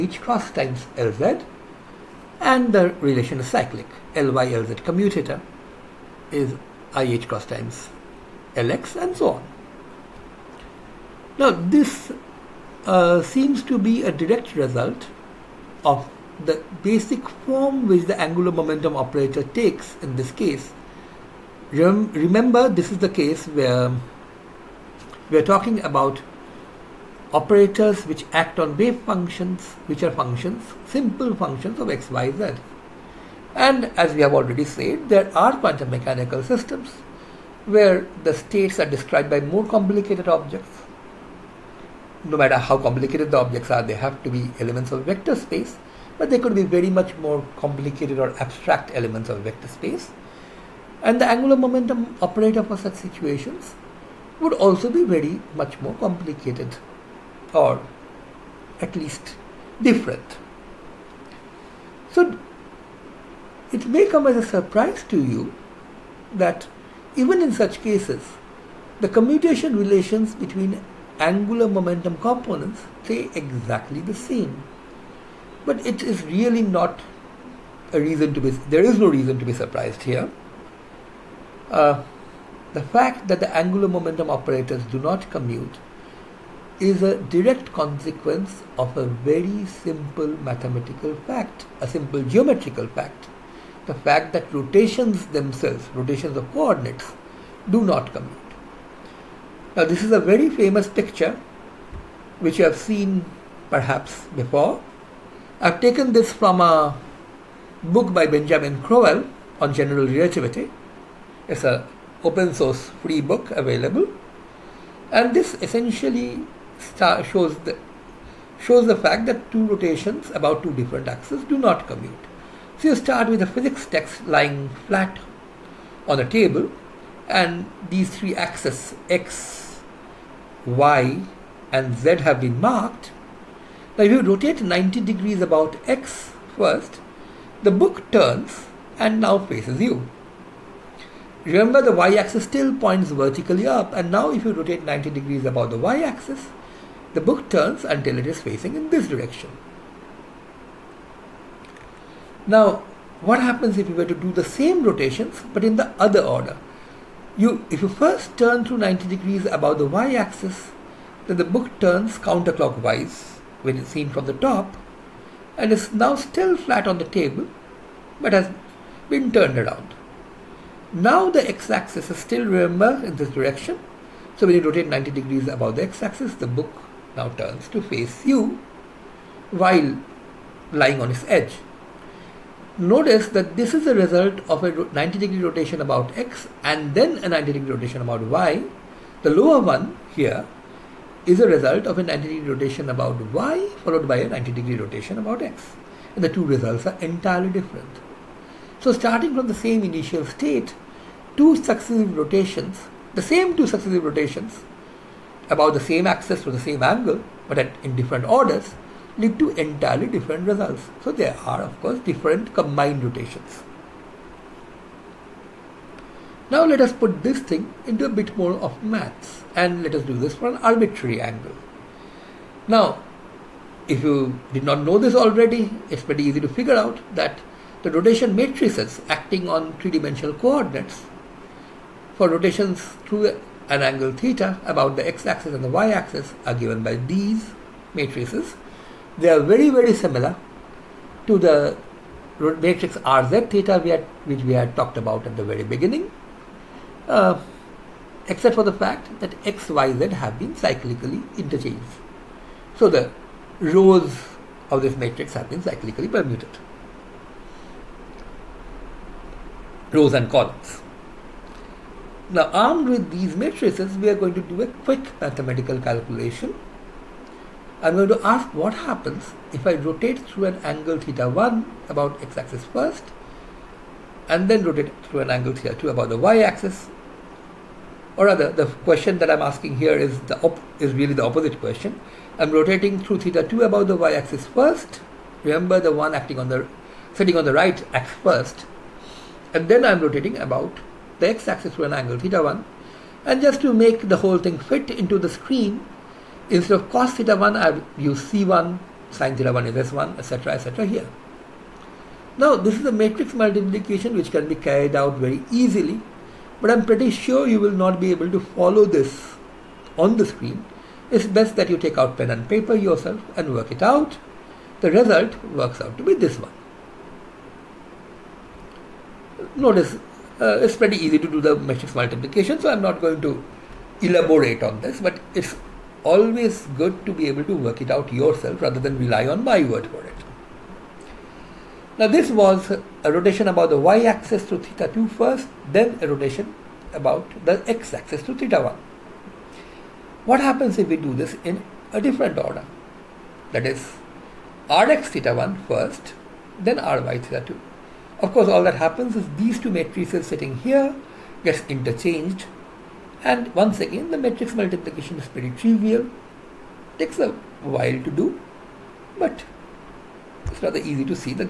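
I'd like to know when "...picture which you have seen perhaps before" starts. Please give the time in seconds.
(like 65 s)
100 s.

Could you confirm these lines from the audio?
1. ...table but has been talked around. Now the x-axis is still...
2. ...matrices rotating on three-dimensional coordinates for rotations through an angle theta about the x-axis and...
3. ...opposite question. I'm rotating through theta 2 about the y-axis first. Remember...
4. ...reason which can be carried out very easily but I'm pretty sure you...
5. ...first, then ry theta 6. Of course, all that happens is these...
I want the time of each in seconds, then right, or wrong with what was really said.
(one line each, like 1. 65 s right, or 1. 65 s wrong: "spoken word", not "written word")
1. 167 s wrong: "turned", not "talked"
2. 228 s wrong: "acting", not "rotating"
3. 281 s right
4. 303 s wrong: "multiplication", not "reason"
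5. 345 s wrong: "2", not "6".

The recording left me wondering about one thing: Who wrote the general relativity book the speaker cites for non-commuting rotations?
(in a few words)
Benjamin Crowell.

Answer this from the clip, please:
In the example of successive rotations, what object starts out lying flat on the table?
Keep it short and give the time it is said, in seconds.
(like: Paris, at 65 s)
A physics text, at 123 s.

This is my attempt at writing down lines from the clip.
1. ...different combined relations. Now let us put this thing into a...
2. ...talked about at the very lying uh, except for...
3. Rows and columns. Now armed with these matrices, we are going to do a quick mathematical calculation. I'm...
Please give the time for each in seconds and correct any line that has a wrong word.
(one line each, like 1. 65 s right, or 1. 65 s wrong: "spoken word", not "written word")
1. 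211 s wrong: "rotations", not "relations"
2. 244 s wrong: "beginning", not "lying"
3. 259 s right.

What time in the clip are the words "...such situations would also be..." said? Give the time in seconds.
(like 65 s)
52 s.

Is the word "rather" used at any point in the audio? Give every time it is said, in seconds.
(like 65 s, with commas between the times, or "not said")
278 s, 328 s, 360 s.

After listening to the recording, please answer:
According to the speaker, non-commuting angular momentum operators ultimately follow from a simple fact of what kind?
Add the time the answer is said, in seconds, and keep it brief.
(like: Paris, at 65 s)
Geometrical, at 92 s.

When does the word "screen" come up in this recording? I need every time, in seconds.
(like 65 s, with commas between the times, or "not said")
295 s, 310 s.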